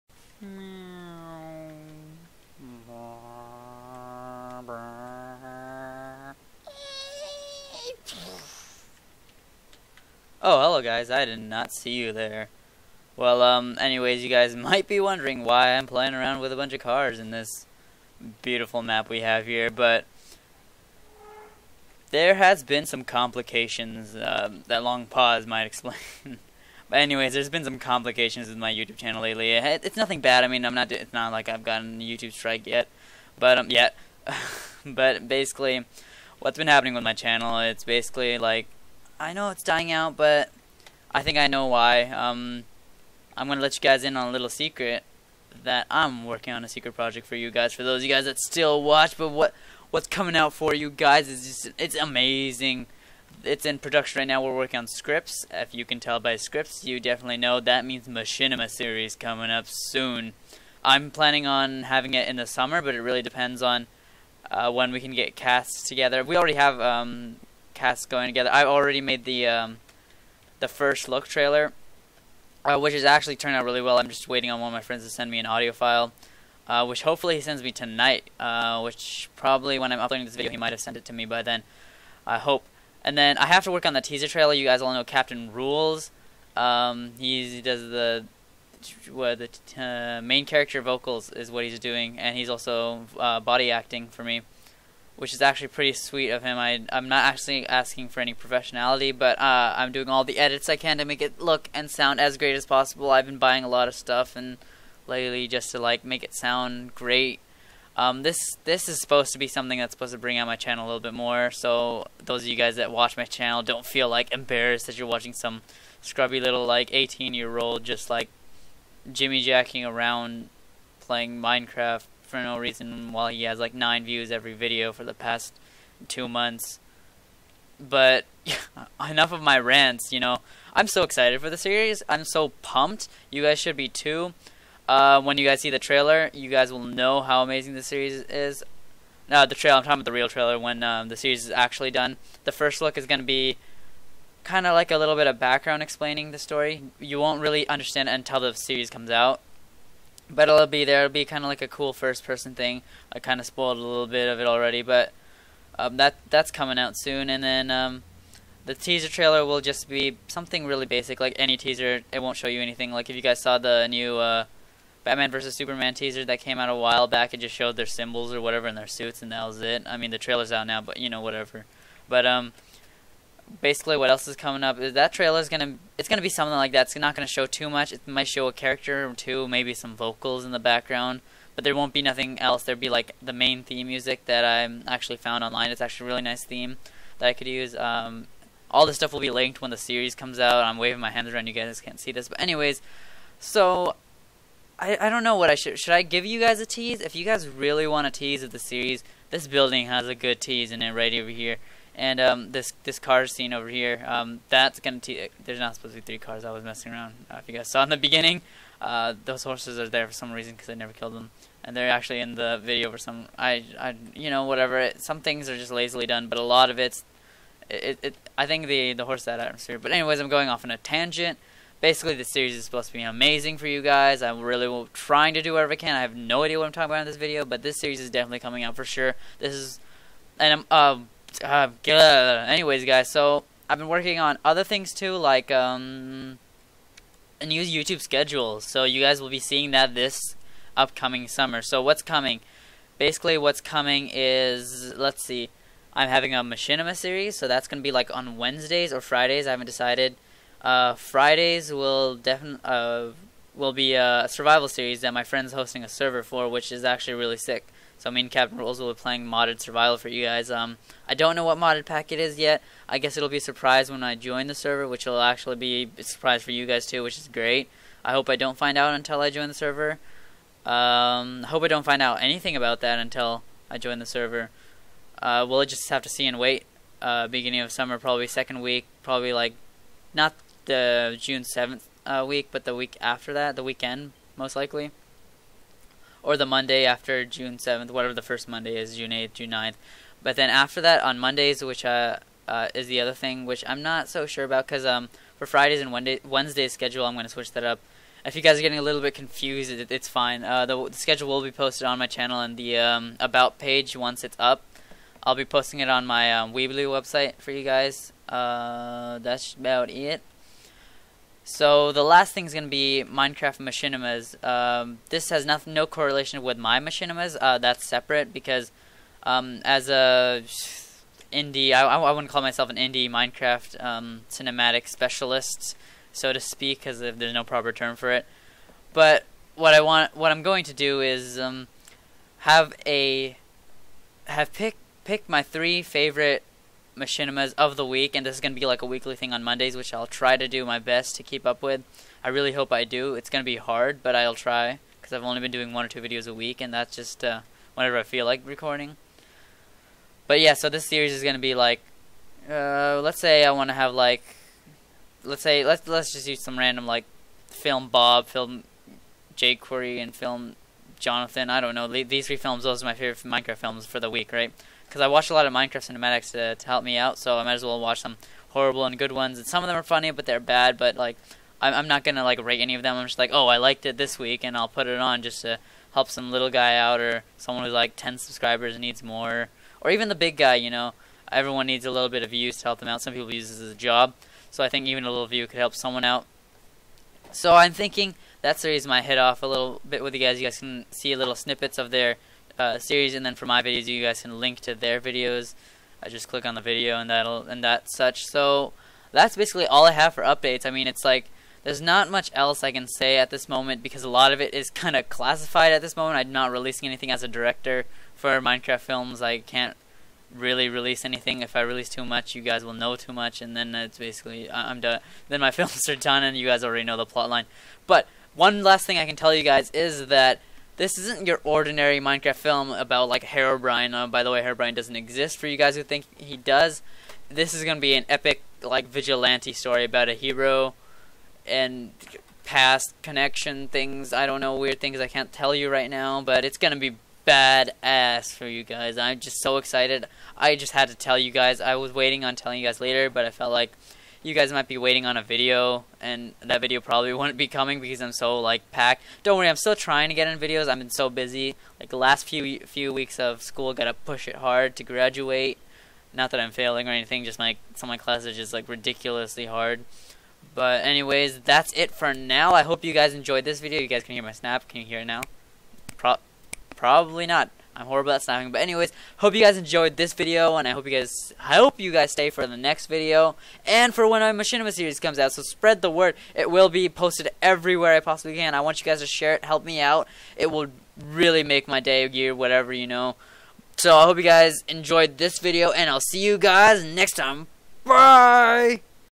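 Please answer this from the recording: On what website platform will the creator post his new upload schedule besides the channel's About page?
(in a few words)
Weebly.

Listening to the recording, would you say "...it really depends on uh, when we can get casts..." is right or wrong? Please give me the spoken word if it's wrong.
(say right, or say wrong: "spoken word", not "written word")
right.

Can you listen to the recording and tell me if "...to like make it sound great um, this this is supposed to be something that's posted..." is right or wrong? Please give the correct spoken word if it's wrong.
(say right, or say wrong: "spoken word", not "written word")
wrong: "supposed", not "posted".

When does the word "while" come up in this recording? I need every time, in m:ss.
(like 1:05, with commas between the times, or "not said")
2:03, 2:46.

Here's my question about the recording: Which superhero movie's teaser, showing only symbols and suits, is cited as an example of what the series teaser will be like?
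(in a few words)
Batman vs Superman.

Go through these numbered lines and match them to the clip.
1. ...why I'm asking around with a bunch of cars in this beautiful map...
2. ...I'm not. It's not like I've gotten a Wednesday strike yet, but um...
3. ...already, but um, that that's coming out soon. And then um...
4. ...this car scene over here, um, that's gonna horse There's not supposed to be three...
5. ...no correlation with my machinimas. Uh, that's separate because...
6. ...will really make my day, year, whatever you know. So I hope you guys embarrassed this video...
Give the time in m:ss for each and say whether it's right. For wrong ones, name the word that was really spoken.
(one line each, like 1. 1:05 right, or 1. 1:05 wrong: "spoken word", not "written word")
1. 0:15 wrong: "playing", not "asking"
2. 0:30 wrong: "YouTube", not "Wednesday"
3. 2:34 right
4. 3:22 wrong: "tease", not "horse"
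5. 5:15 right
6. 8:00 wrong: "enjoyed", not "embarrassed".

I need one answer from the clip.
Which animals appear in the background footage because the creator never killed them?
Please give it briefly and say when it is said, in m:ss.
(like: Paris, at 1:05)
horses, at 3:29.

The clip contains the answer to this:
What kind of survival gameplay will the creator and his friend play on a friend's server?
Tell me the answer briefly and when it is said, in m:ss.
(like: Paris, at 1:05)
modded survival, at 4:19.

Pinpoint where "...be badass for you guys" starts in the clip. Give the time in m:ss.
7:16.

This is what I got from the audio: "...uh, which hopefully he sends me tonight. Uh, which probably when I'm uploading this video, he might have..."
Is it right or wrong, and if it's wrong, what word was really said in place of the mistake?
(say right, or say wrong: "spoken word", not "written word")
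right.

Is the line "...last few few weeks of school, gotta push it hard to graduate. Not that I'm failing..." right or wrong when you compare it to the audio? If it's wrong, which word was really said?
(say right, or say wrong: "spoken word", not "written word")
right.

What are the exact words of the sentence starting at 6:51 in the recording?
If I release too much, you guys will know too much, and then it's basically I'm done.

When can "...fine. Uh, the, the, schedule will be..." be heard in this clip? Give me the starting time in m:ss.
5:00.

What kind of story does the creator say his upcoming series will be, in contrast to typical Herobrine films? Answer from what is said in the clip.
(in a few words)
vigilante story.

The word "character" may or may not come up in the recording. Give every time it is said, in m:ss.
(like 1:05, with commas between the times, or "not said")
1:30, 2:58.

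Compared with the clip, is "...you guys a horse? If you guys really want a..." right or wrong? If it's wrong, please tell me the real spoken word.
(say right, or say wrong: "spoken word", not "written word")
wrong: "tease", not "horse".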